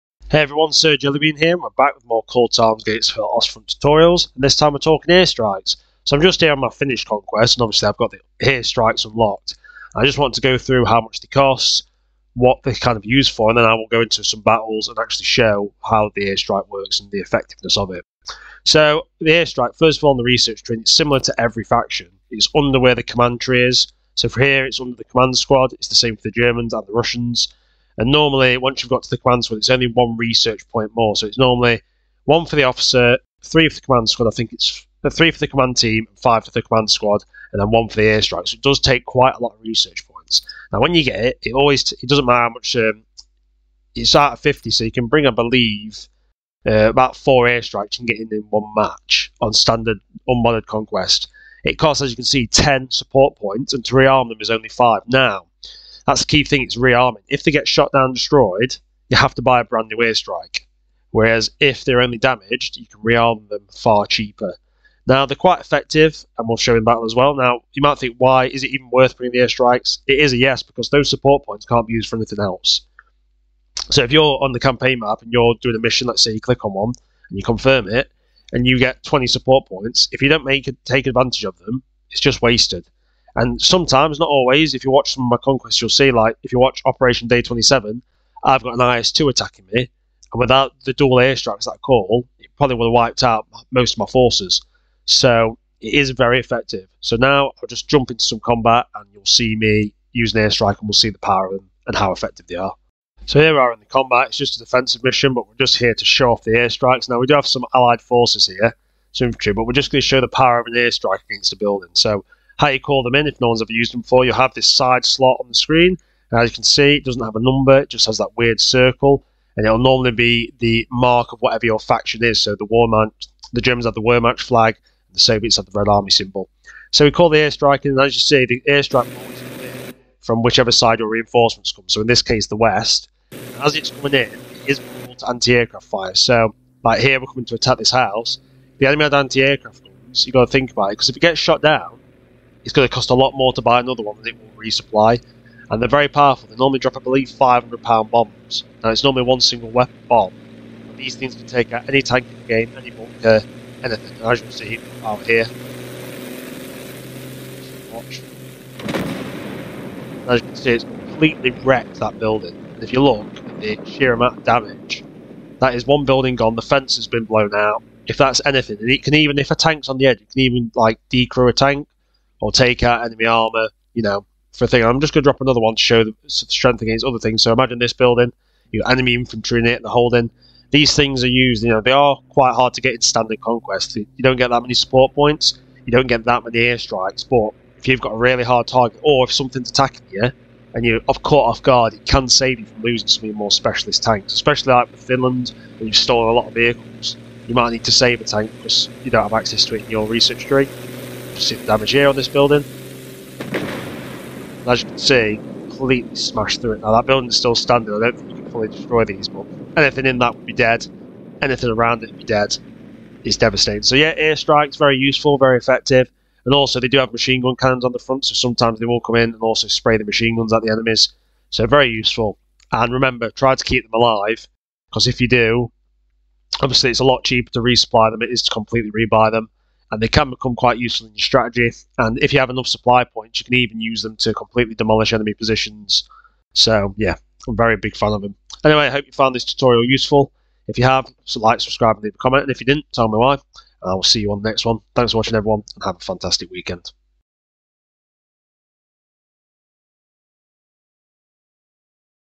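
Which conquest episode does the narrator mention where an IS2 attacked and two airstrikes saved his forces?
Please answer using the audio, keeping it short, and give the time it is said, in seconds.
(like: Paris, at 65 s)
Operation Day 27, at 86 s.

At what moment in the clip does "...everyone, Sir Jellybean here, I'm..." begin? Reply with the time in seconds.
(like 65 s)
0 s.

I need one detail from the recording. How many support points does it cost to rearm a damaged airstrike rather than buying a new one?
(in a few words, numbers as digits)
5.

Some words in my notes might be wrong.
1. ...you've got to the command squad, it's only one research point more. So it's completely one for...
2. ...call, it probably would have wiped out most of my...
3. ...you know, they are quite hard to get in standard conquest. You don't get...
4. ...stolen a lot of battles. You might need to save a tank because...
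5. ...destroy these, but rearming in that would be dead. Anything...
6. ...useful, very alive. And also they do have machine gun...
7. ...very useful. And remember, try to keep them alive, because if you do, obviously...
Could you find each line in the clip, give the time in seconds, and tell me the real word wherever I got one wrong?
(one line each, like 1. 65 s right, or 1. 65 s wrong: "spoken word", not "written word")
1. 28 s wrong: "normally", not "completely"
2. 91 s right
3. 181 s right
4. 195 s wrong: "vehicles", not "battles"
5. 208 s wrong: "anything", not "rearming"
6. 214 s wrong: "effective", not "alive"
7. 221 s right.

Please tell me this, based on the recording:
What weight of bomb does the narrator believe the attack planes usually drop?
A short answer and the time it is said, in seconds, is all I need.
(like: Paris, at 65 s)
500 pound, at 147 s.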